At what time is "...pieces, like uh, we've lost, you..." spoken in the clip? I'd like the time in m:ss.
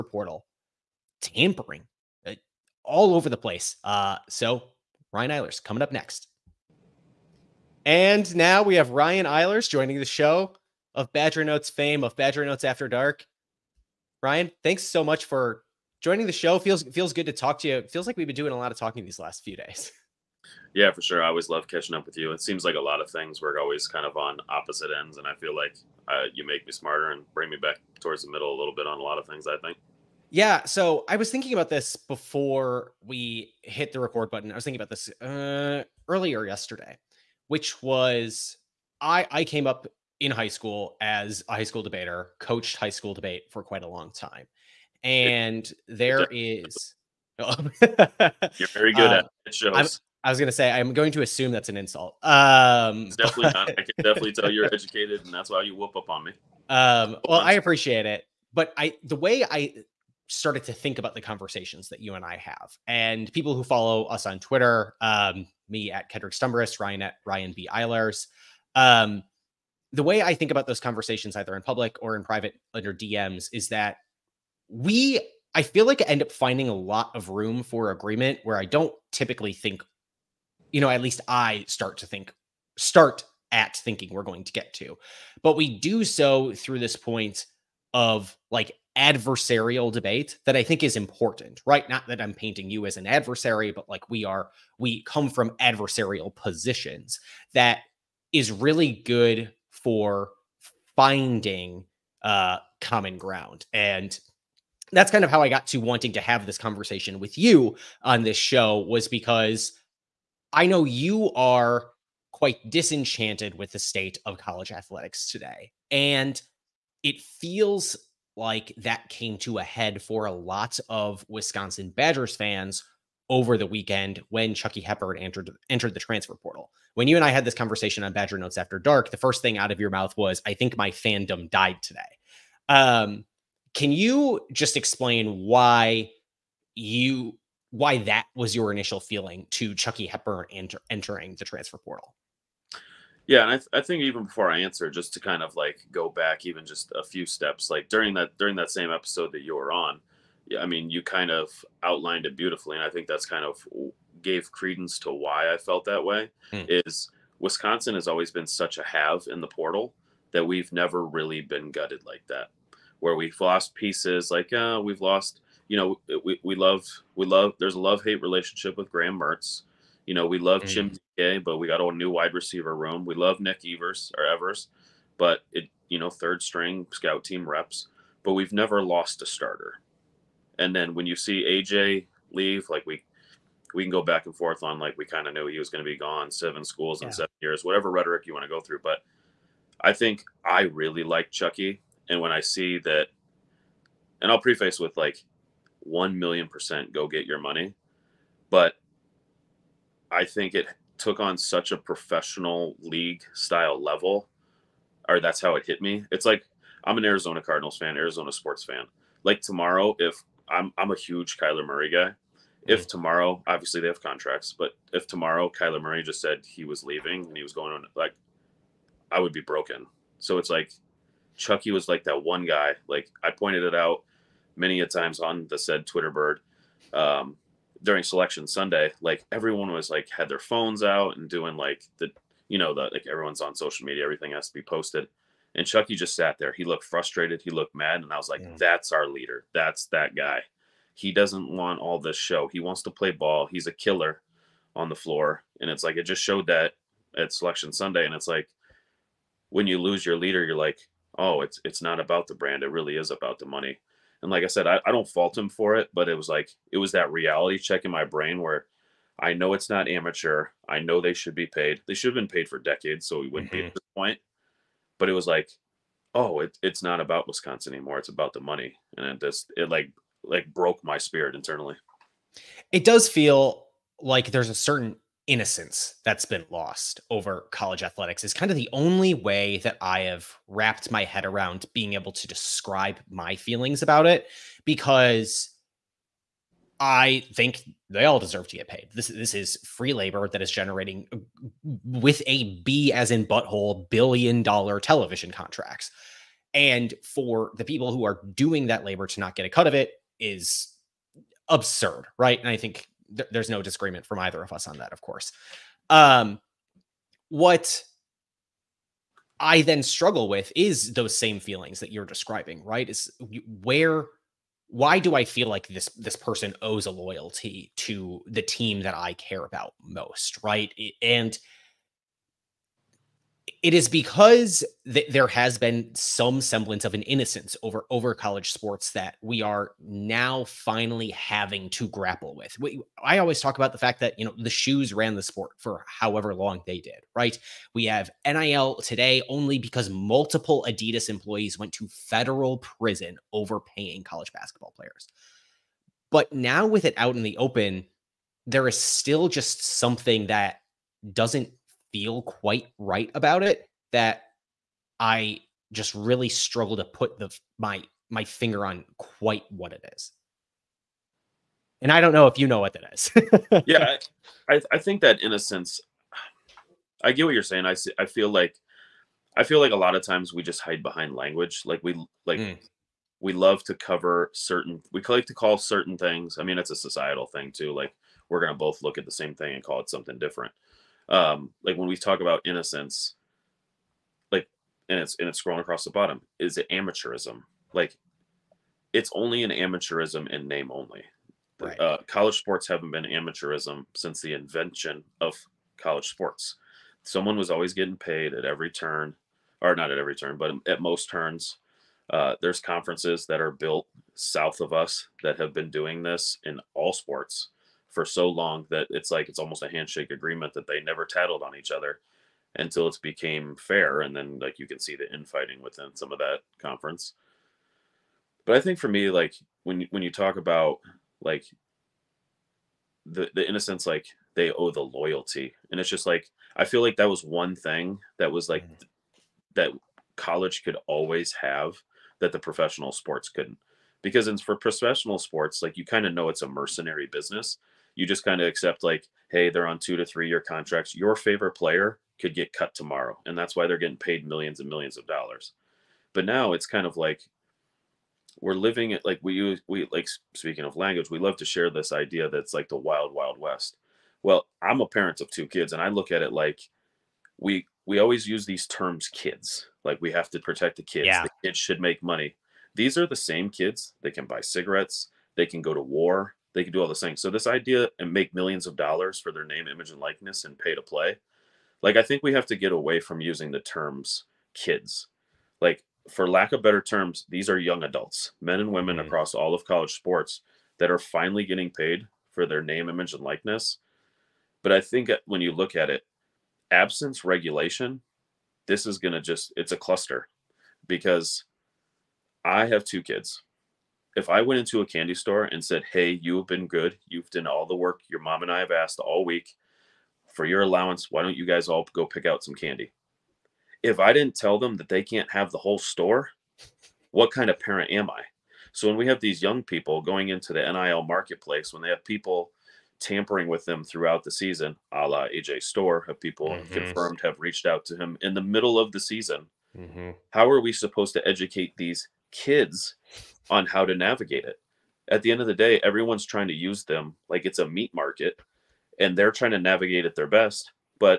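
2:43.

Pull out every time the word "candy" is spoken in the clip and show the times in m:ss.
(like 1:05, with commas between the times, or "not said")
8:14, 8:22.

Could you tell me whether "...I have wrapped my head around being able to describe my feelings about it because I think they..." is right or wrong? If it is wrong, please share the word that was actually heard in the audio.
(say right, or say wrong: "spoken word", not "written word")
right.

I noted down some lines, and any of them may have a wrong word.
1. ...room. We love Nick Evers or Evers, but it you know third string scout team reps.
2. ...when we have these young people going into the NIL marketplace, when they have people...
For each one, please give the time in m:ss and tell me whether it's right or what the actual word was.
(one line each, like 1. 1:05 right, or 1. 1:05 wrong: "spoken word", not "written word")
1. 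2:52 right
2. 8:28 right.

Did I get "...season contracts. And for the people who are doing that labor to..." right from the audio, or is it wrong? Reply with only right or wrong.
wrong.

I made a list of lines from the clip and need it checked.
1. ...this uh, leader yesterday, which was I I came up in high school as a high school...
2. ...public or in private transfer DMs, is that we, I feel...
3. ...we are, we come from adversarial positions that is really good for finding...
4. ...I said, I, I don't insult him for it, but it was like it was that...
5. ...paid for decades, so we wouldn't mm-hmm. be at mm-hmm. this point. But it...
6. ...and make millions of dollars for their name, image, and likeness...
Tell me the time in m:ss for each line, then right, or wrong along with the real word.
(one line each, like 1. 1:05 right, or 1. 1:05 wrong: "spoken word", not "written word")
1. 0:34 wrong: "earlier", not "leader"
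2. 1:11 wrong: "under", not "transfer"
3. 1:34 right
4. 4:14 wrong: "fault", not "insult"
5. 4:22 right
6. 7:47 right.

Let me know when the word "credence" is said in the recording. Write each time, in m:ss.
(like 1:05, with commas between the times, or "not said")
2:34.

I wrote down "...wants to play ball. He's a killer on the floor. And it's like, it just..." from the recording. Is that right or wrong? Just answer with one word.
right.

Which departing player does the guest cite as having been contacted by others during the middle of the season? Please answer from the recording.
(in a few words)
AJ Storr.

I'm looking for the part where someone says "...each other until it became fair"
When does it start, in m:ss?
6:51.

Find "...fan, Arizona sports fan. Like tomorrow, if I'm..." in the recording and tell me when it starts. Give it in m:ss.
3:27.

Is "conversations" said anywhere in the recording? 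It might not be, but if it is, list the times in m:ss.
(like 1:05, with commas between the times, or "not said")
1:01, 1:10, 1:46, 2:07.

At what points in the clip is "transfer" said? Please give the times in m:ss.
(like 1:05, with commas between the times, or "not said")
2:05, 2:21.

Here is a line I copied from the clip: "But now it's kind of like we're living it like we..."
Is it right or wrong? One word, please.
right.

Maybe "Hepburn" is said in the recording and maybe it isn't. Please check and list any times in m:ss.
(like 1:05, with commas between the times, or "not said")
2:04, 2:20.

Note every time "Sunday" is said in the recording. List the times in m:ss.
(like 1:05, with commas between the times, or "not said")
3:48, 4:07.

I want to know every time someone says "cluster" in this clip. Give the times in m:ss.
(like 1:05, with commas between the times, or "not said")
8:09.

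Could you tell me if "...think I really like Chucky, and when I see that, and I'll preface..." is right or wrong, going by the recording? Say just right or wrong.
right.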